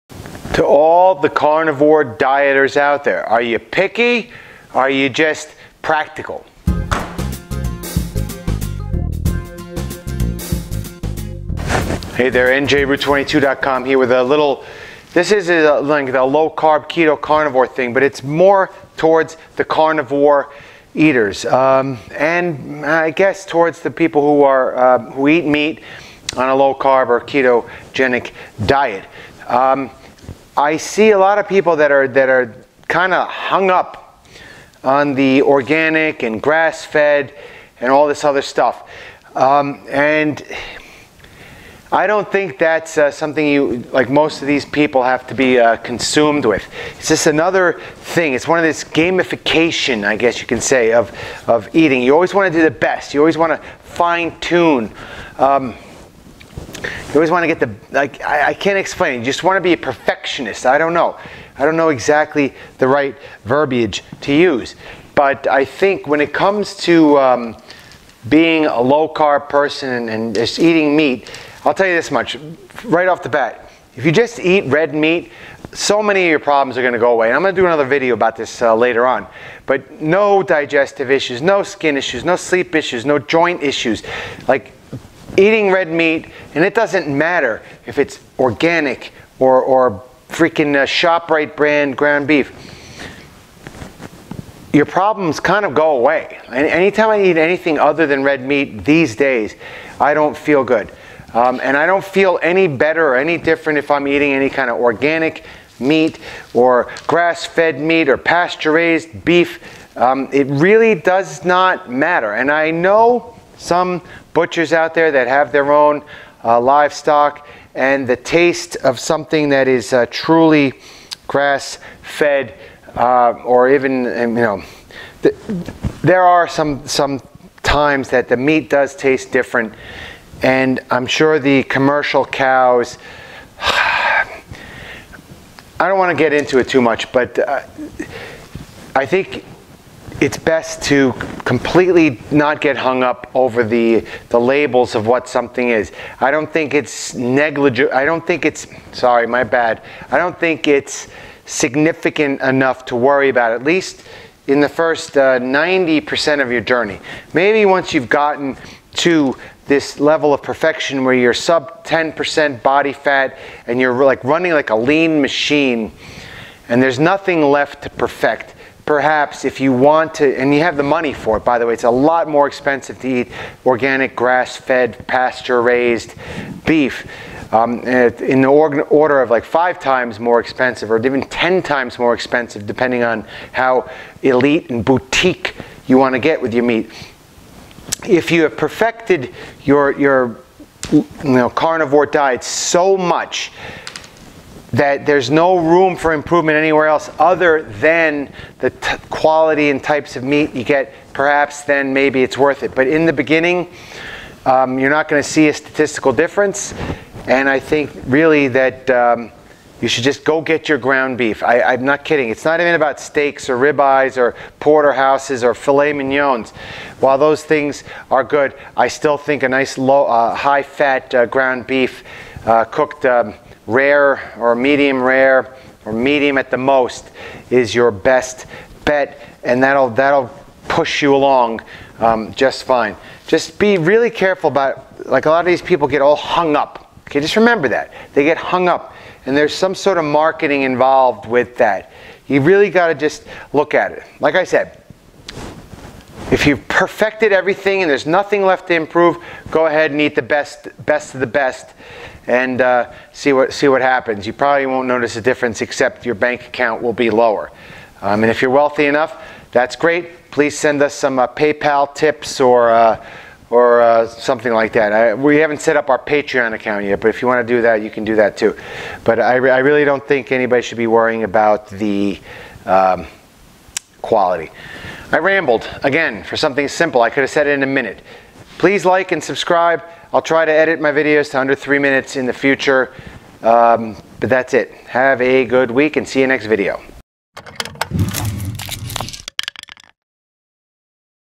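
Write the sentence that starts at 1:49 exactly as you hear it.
Um, it really does not matter.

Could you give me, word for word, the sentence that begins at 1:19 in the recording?
But no digestive issues, no skin issues, no sleep issues, no joint issues.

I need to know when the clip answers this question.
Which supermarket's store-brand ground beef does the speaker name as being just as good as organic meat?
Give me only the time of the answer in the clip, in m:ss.
1:30.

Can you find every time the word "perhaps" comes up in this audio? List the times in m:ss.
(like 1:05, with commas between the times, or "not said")
2:48, 3:21.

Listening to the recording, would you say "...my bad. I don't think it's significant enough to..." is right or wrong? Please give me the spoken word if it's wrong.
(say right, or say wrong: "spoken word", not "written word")
right.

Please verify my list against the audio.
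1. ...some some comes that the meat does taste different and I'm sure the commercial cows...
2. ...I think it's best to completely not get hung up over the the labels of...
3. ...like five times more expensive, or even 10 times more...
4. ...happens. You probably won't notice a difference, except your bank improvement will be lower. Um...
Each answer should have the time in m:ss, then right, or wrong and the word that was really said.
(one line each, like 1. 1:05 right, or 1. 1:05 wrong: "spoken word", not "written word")
1. 2:06 wrong: "times", not "comes"
2. 2:18 right
3. 2:59 right
4. 4:13 wrong: "account", not "improvement".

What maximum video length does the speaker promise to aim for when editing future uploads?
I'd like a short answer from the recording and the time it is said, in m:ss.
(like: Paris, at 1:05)
under 3 minutes, at 4:41.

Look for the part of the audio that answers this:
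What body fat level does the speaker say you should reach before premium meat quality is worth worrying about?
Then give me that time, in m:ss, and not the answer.
2:41.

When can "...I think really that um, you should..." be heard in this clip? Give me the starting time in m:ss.
3:27.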